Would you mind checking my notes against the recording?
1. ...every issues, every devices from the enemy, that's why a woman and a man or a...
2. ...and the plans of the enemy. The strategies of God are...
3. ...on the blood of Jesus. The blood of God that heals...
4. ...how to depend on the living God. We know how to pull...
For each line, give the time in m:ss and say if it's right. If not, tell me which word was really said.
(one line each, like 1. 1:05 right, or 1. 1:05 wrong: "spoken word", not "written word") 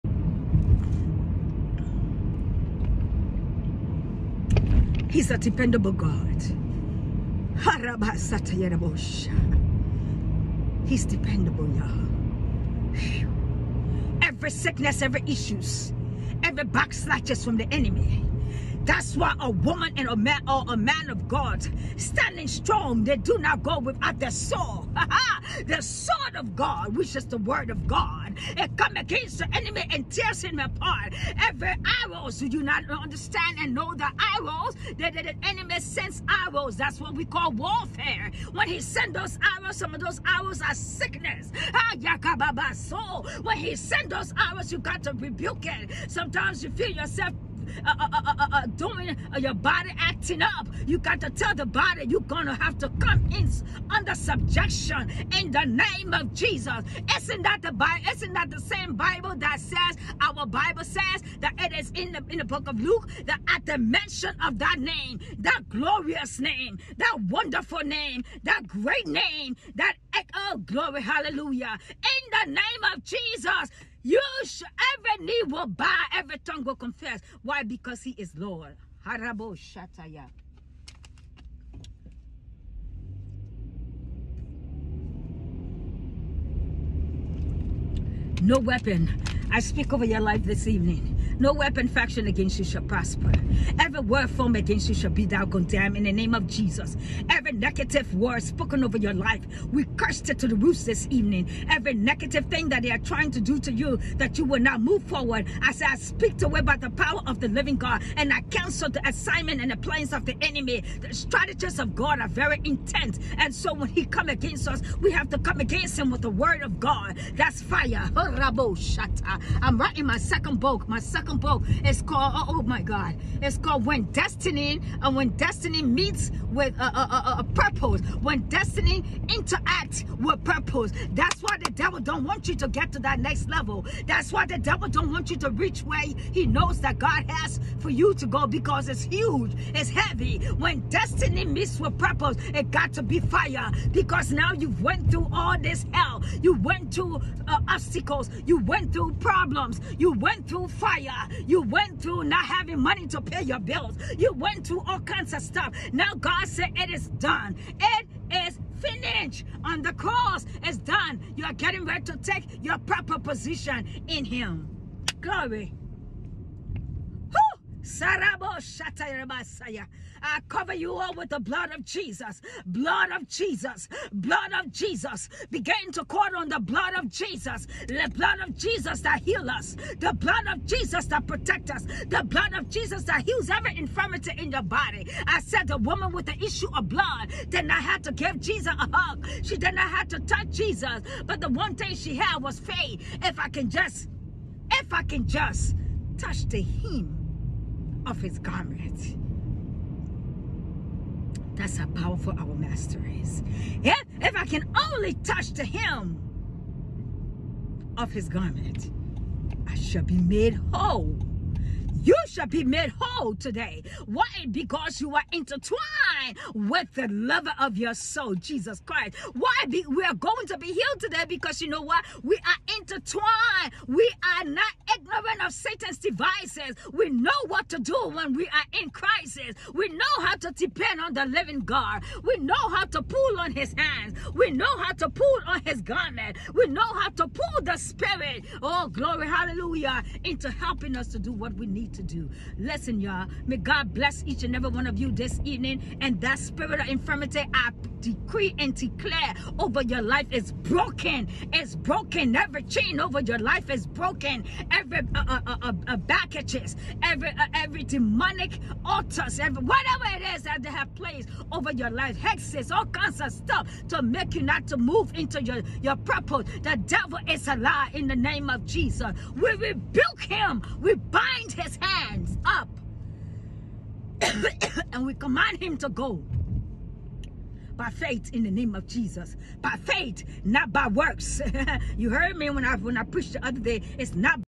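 1. 0:15 wrong: "backslatches", not "devices"
2. 1:49 right
3. 2:56 wrong: "Jesus", not "God"
4. 3:50 right.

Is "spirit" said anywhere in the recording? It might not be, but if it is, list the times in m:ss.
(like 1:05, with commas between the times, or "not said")
3:57, 4:06.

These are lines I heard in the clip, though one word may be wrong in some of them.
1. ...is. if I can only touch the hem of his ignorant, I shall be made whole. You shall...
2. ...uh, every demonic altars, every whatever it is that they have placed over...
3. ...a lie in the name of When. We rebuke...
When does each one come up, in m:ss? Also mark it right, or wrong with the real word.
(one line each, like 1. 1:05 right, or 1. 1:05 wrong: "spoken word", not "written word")
1. 3:23 wrong: "garment", not "ignorant"
2. 4:17 right
3. 4:27 wrong: "Jesus", not "When".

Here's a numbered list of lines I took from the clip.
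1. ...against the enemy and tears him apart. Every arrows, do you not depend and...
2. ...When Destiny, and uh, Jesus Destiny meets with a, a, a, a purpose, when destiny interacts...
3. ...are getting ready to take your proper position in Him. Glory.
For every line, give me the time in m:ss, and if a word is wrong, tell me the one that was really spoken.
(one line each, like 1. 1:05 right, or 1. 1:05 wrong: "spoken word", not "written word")
1. 0:28 wrong: "understand", not "depend"
2. 2:03 wrong: "When", not "Jesus"
3. 2:41 right.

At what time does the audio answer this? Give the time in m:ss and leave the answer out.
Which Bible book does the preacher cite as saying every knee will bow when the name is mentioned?
1:02.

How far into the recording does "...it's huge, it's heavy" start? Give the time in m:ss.
2:18.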